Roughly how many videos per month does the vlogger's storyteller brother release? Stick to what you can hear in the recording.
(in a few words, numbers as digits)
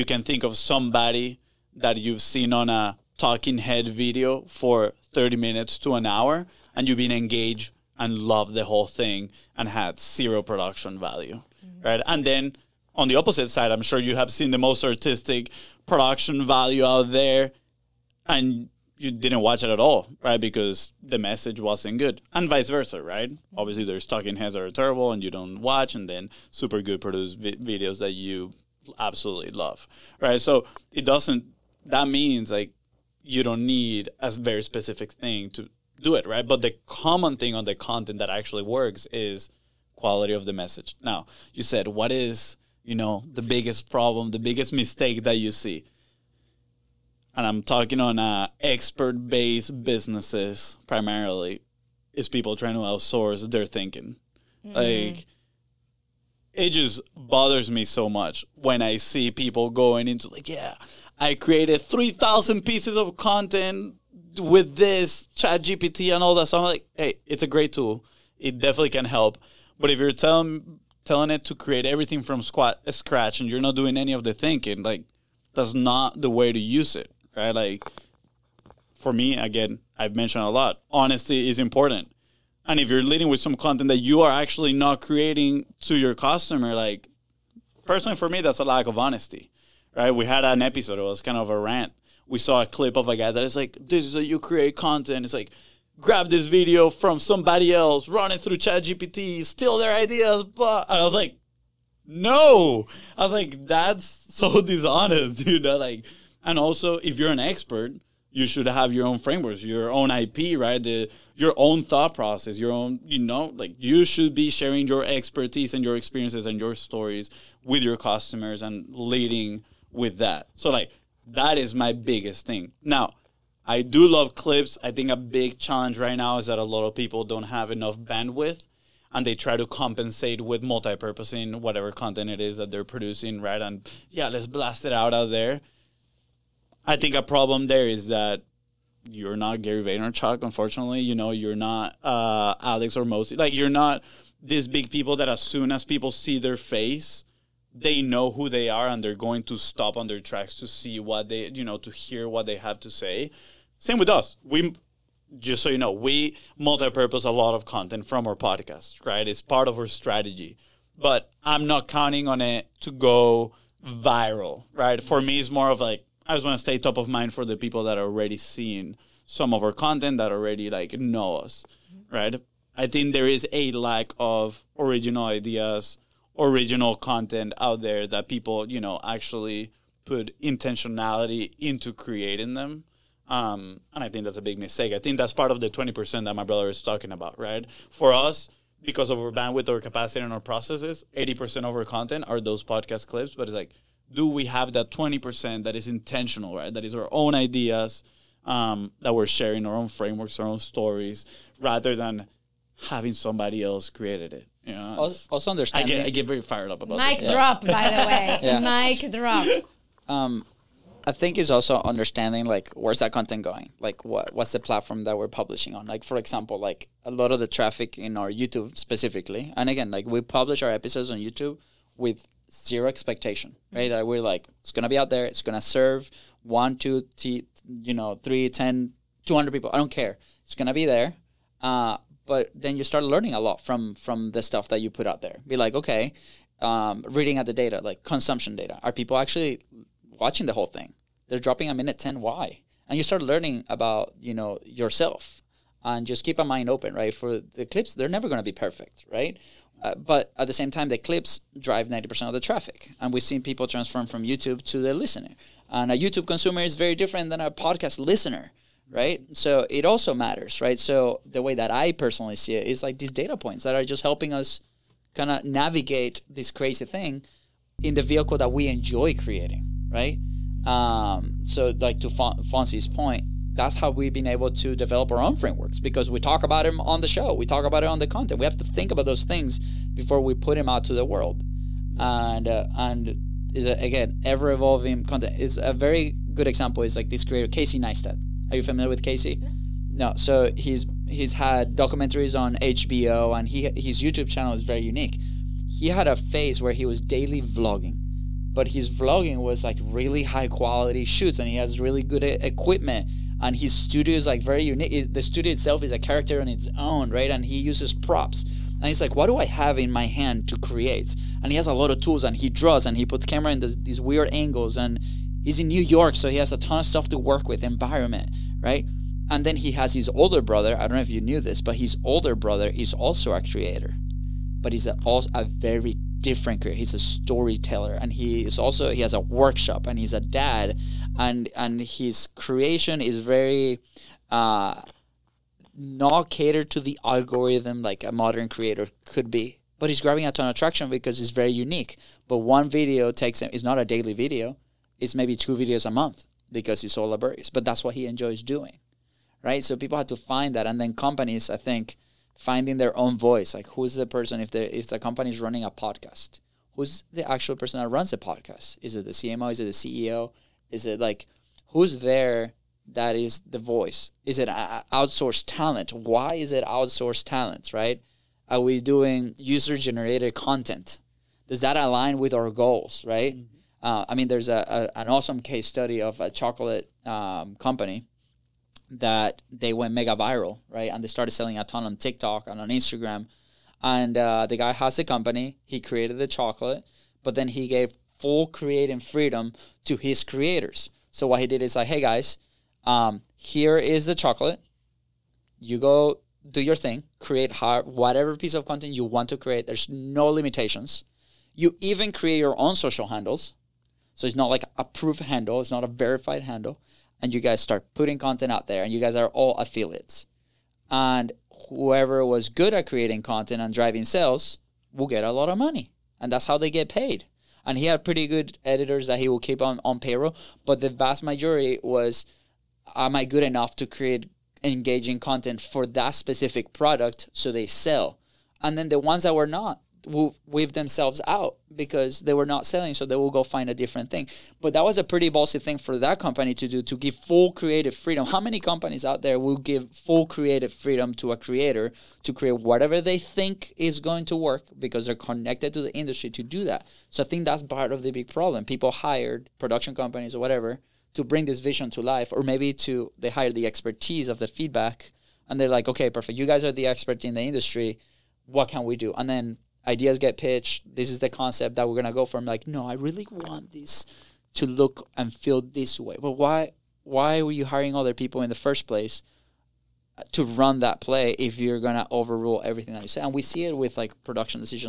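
2.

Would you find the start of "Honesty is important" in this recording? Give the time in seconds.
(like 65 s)
80 s.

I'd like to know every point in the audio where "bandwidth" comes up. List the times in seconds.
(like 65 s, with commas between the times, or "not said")
127 s, 189 s.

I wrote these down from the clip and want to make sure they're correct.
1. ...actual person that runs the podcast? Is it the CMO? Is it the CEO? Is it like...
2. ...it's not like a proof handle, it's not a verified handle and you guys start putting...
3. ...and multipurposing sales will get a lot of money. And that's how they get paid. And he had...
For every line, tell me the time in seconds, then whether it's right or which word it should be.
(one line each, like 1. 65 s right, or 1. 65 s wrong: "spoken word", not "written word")
1. 357 s right
2. 404 s right
3. 413 s wrong: "driving", not "multipurposing".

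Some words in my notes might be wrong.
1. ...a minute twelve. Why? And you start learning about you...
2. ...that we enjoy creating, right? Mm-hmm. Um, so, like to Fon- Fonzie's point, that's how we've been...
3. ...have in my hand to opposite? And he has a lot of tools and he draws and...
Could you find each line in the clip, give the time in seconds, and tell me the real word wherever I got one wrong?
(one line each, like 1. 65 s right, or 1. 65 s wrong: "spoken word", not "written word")
1. 241 s wrong: "ten", not "twelve"
2. 268 s right
3. 309 s wrong: "create", not "opposite".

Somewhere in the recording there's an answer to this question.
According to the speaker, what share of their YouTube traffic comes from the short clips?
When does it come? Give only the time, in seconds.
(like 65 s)
251 s.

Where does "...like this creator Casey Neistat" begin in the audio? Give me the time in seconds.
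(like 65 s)
286 s.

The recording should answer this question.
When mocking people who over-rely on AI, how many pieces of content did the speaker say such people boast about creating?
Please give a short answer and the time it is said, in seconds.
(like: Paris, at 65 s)
3,000, at 61 s.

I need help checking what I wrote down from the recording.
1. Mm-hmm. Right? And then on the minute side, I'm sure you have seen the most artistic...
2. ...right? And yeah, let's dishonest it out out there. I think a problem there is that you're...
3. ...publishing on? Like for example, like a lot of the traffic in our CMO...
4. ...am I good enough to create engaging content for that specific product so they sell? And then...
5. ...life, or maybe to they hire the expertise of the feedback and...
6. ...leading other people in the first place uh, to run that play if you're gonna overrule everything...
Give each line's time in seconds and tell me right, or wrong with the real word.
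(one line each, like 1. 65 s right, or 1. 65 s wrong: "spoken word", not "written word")
1. 11 s wrong: "opposite", not "minute"
2. 133 s wrong: "blast", not "dishonest"
3. 215 s wrong: "YouTube", not "CMO"
4. 422 s right
5. 452 s right
6. 467 s wrong: "hiring", not "leading".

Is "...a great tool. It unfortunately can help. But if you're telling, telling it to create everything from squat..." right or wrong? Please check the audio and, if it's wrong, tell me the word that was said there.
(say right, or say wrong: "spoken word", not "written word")
wrong: "definitely", not "unfortunately".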